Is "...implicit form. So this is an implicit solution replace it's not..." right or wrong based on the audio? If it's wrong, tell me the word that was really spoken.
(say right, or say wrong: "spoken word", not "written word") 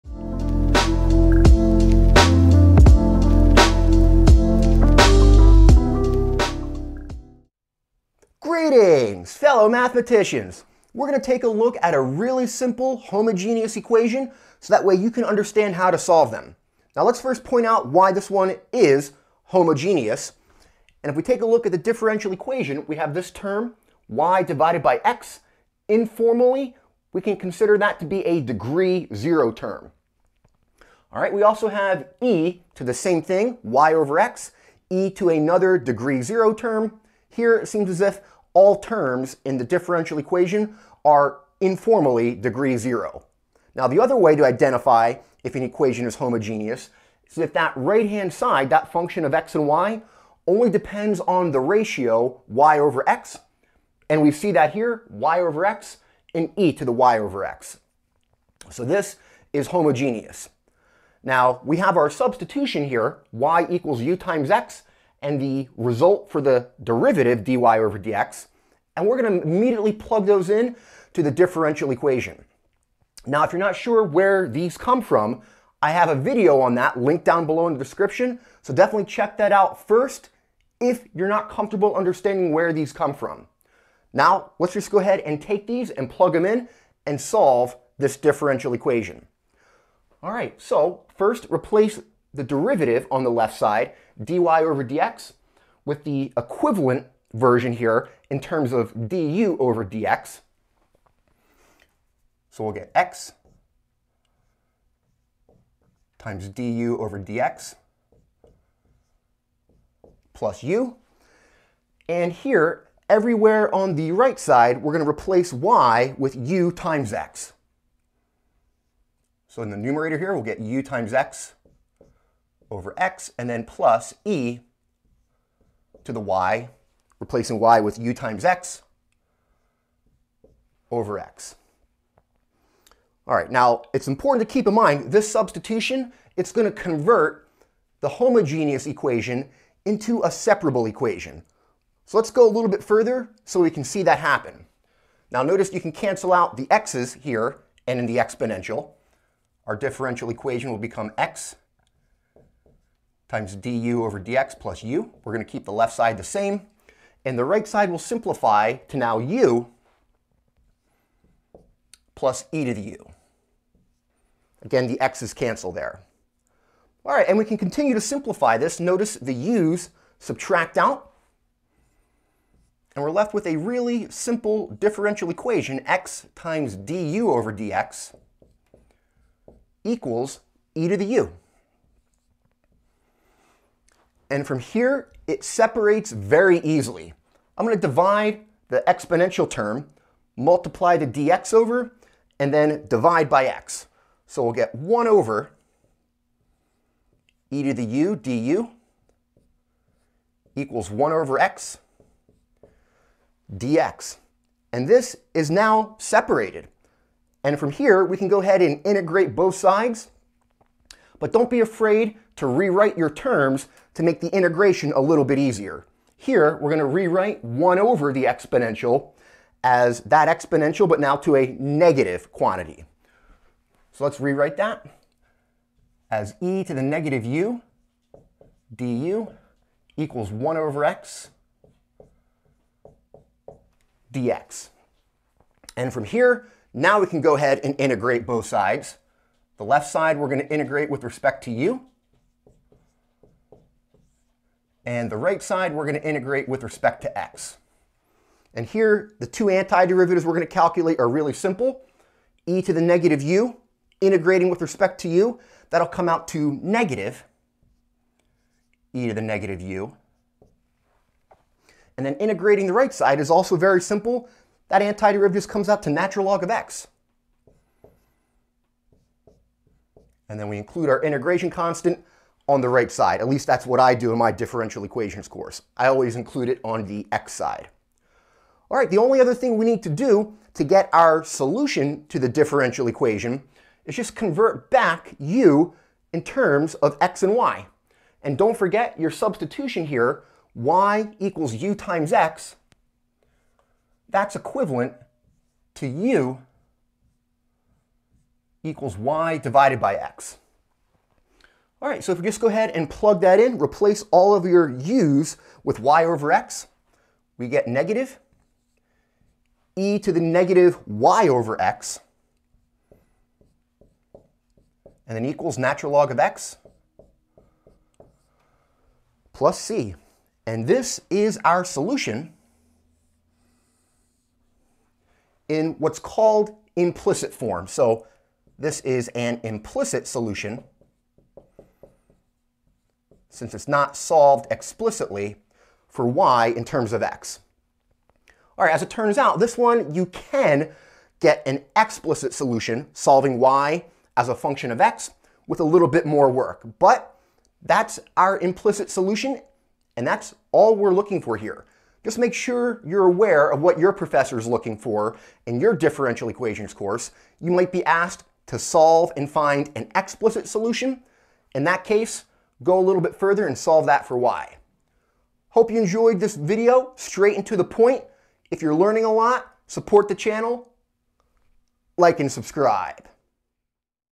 wrong: "since", not "replace".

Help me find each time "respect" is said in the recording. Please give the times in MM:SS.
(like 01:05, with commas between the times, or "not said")
04:01, 04:06, 04:14.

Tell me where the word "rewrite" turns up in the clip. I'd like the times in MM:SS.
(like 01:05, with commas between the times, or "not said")
03:32, 03:36, 03:44.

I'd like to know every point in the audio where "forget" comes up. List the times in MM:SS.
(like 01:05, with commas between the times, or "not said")
04:48.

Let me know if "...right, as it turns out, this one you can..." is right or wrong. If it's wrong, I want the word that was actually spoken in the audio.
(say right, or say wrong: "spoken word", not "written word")
right.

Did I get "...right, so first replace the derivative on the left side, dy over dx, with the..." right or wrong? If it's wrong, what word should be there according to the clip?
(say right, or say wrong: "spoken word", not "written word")
right.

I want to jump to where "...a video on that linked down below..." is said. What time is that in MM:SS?
01:16.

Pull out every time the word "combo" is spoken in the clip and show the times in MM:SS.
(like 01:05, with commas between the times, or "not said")
not said.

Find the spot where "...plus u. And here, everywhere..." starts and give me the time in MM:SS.
01:50.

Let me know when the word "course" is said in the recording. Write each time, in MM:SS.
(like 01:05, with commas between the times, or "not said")
04:35, 05:56.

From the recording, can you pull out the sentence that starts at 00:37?
Here it seems as if all terms in the differential equation are informally degree zero.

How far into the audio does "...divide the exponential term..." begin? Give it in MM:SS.
03:07.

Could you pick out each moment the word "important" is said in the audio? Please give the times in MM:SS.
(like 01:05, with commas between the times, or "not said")
02:14.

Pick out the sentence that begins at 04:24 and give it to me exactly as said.
That antiderivative comes out to natural log of x.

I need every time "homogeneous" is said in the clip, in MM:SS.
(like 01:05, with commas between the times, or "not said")
00:12, 00:19, 00:46, 00:59, 02:18.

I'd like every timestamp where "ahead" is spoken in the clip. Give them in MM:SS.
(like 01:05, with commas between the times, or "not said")
01:24, 03:28, 03:57, 05:02.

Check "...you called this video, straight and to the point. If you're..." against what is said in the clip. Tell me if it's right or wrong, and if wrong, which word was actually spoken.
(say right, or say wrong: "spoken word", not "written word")
wrong: "enjoyed", not "called".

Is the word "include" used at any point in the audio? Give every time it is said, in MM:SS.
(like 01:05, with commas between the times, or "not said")
04:30, 04:36.